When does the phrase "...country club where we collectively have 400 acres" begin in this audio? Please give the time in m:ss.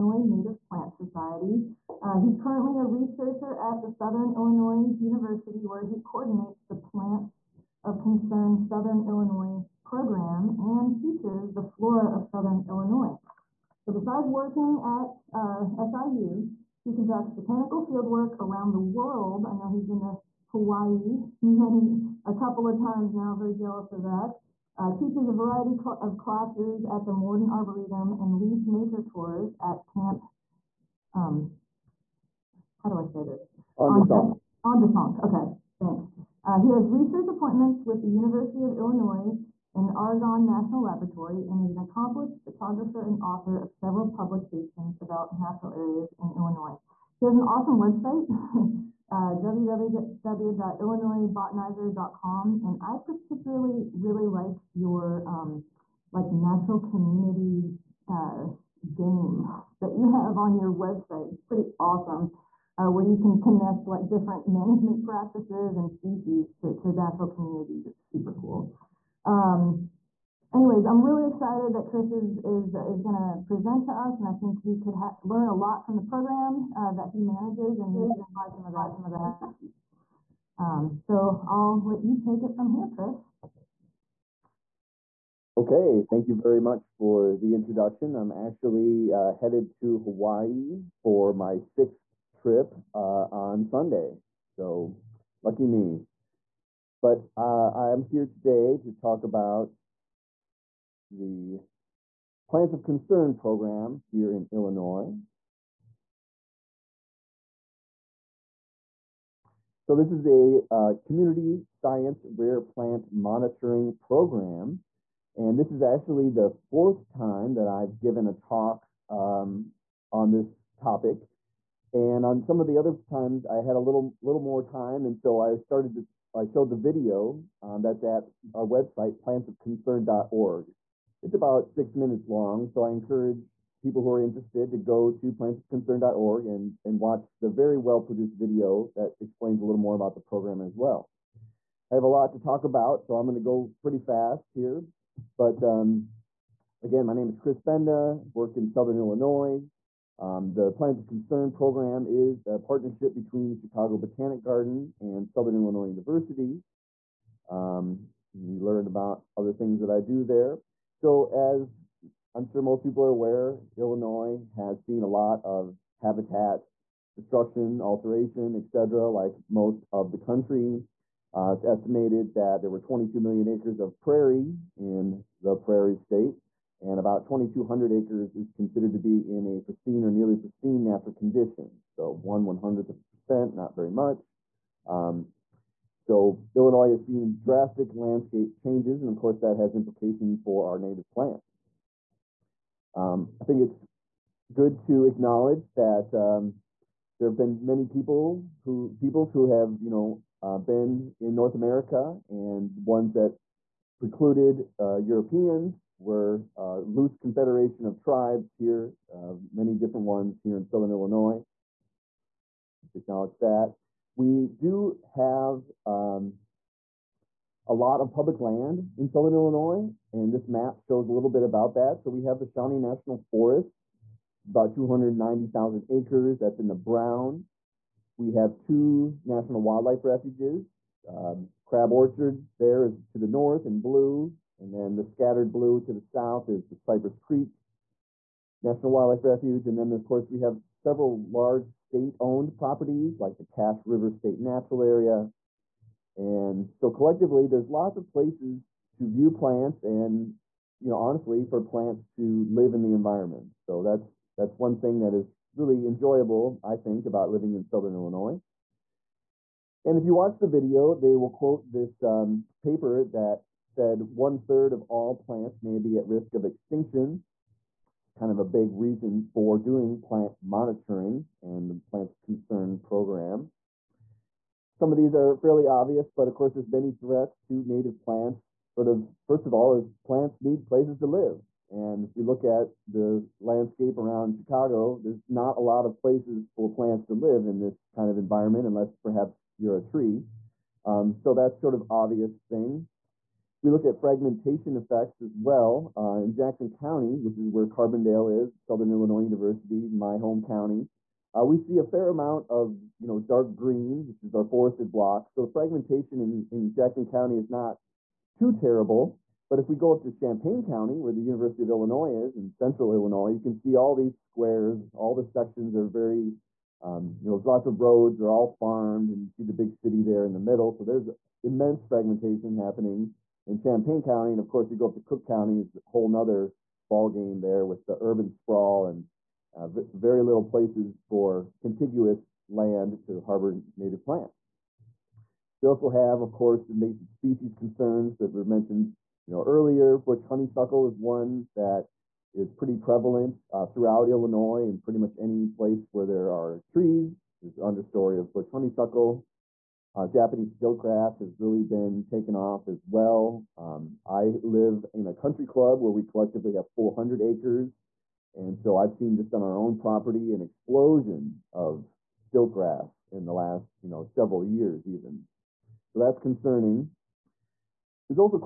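5:55.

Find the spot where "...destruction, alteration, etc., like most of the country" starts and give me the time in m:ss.
2:47.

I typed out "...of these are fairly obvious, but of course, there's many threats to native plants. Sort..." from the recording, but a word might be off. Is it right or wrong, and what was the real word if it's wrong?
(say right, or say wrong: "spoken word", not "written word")
right.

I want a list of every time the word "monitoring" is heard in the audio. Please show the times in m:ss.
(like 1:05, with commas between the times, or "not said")
1:53, 4:30.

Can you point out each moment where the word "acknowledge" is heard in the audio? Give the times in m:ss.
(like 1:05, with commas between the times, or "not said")
3:15, 3:32.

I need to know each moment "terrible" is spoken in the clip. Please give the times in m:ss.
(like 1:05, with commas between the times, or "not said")
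5:08.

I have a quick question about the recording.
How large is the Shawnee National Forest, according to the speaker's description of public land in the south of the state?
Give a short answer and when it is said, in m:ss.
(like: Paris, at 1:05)
290,000 acres, at 3:44.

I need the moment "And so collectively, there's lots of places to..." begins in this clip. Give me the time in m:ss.
4:06.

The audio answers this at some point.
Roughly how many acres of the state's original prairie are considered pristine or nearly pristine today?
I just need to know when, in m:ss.
2:57.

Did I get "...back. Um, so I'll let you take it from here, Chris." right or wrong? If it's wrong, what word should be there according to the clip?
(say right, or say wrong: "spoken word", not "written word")
right.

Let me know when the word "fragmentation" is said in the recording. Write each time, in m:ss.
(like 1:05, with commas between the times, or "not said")
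4:53, 5:05, 5:21.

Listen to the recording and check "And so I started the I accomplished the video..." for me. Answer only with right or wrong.
wrong.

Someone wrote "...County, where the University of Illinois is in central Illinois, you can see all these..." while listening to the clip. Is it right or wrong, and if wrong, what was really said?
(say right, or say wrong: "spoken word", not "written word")
right.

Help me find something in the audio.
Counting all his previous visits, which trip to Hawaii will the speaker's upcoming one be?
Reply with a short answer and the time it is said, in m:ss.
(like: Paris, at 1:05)
sixth trip, at 1:31.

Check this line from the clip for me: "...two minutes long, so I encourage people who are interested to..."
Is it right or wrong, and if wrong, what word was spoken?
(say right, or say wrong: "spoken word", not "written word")
wrong: "six", not "two".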